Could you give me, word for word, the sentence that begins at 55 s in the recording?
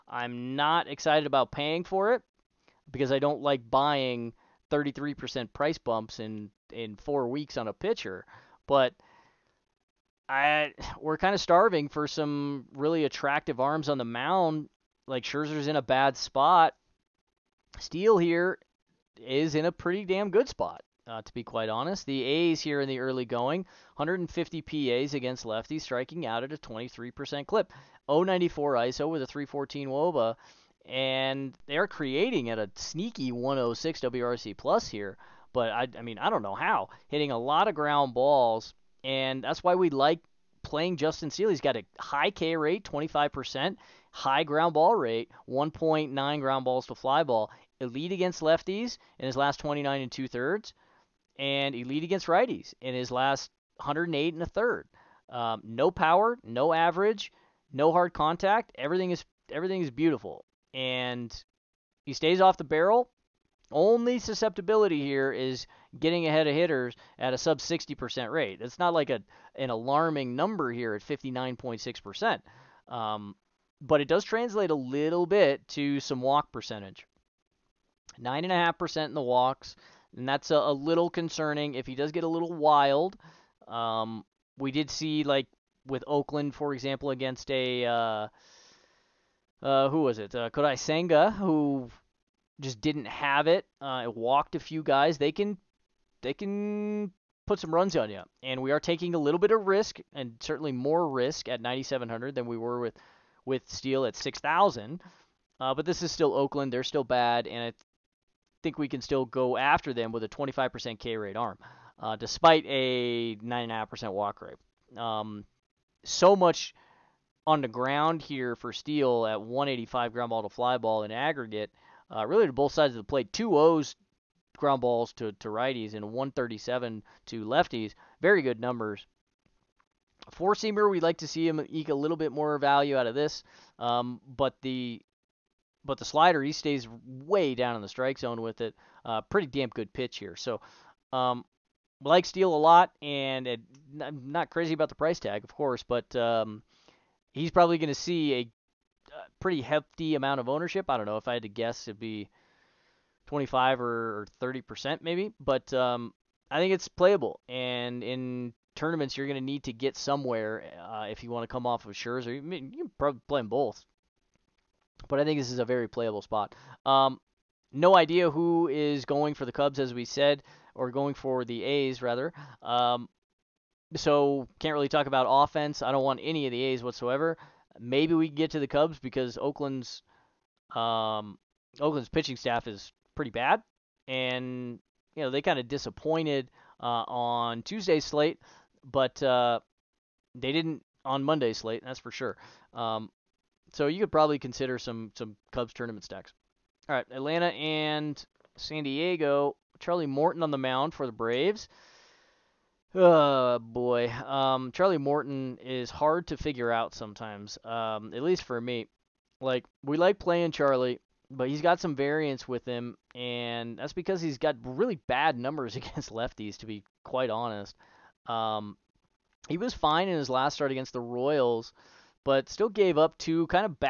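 Um, no power, no average, no hard contact.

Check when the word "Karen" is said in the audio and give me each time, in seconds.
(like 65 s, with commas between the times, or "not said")
not said.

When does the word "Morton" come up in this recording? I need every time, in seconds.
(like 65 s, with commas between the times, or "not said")
200 s, 204 s.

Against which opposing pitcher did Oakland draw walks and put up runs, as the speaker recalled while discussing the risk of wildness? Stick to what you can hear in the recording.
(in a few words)
Kodai Senga.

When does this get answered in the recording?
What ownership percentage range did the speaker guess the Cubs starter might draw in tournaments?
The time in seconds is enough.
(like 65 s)
153 s.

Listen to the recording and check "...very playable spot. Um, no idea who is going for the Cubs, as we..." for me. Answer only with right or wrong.
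right.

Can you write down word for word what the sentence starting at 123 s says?
Two O's ground balls to, to righties and 137 to lefties.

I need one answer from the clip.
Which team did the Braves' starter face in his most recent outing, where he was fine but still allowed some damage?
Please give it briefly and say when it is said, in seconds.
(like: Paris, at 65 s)
Royals, at 221 s.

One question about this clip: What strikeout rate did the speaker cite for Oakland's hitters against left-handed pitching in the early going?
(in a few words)
23%.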